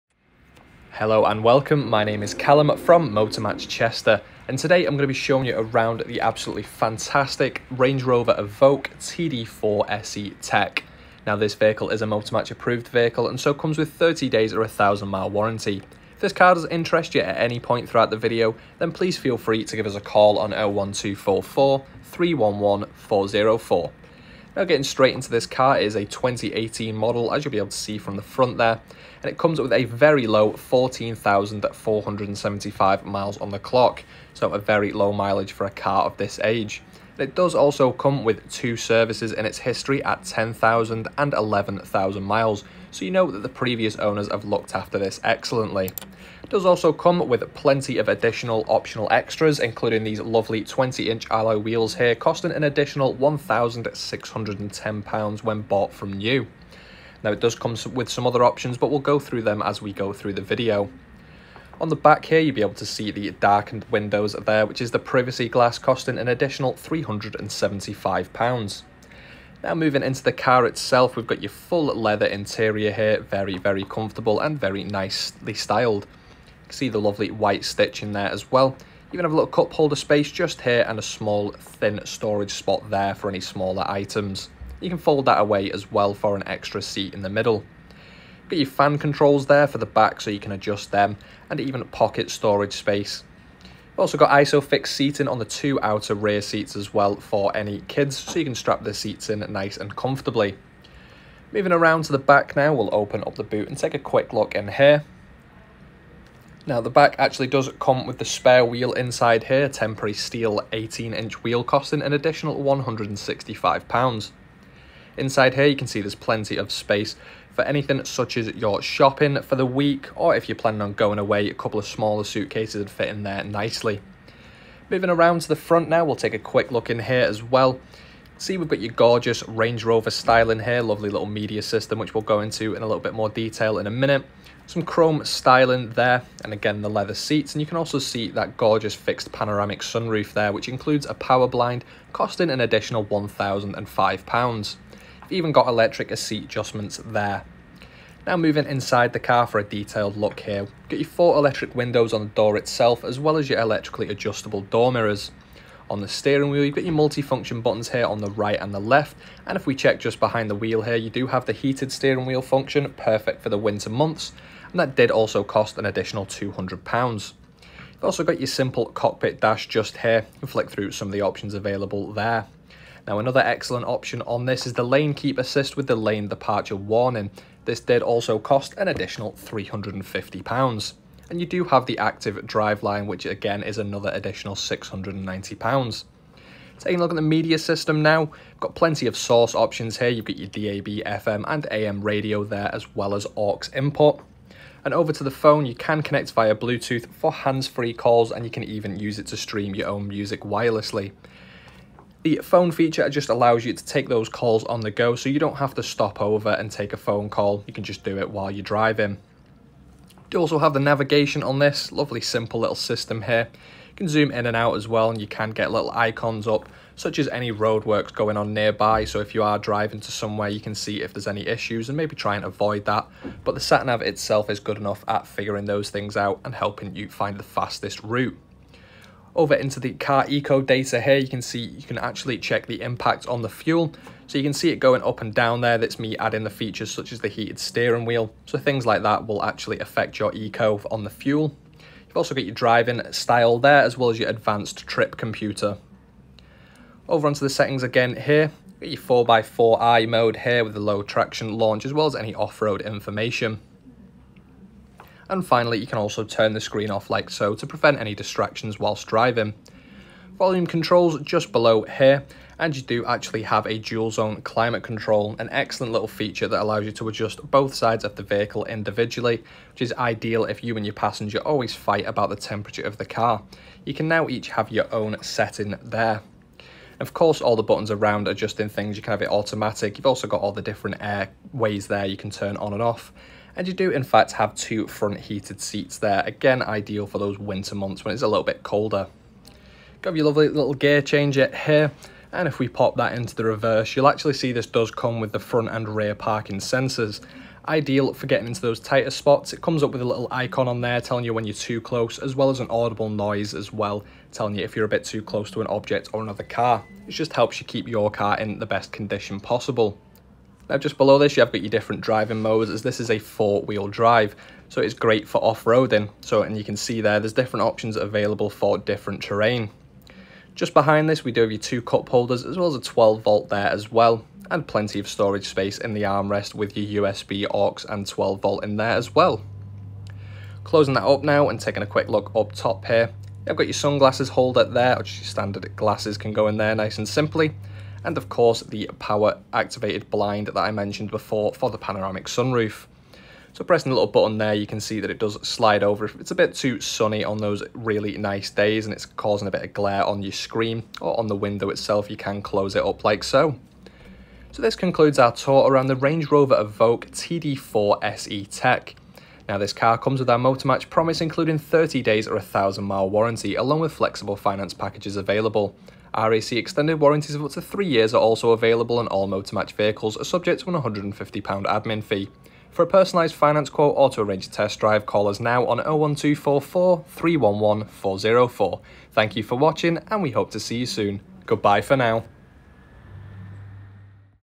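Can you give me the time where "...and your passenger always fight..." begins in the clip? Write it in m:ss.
4:30.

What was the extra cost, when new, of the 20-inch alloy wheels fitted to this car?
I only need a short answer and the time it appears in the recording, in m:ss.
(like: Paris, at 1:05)
£1,610, at 0:53.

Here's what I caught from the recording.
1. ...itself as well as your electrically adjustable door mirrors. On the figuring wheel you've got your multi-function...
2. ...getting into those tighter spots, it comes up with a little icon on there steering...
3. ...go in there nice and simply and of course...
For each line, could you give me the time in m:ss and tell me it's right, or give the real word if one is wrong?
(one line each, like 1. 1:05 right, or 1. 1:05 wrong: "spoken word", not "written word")
1. 2:32 wrong: "steering", not "figuring"
2. 4:58 wrong: "telling", not "steering"
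3. 5:36 right.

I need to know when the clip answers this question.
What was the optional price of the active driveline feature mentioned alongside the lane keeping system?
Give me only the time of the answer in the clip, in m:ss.
3:04.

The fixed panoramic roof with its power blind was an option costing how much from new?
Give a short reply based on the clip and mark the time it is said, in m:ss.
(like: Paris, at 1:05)
£1,005, at 2:23.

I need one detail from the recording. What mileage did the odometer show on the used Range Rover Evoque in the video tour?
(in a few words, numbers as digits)
14,475.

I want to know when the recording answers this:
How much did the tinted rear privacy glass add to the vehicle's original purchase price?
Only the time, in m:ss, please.
1:06.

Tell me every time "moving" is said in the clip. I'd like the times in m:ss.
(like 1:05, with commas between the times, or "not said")
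1:09, 1:41, 2:04, 2:28.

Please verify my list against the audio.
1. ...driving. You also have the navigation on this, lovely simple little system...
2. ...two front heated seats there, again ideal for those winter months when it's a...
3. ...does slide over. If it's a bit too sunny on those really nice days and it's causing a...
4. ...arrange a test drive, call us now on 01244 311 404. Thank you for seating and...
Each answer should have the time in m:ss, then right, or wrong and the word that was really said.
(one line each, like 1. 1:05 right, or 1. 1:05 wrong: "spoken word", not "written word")
1. 3:28 right
2. 4:44 right
3. 5:45 right
4. 6:14 wrong: "watching", not "seating".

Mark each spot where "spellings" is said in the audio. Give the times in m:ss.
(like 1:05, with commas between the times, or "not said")
not said.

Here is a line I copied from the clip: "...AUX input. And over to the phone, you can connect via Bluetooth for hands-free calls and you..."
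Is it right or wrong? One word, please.
right.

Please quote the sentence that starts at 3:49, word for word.
Over into the car eco data here, you can see you can actually check the impact on the fuel.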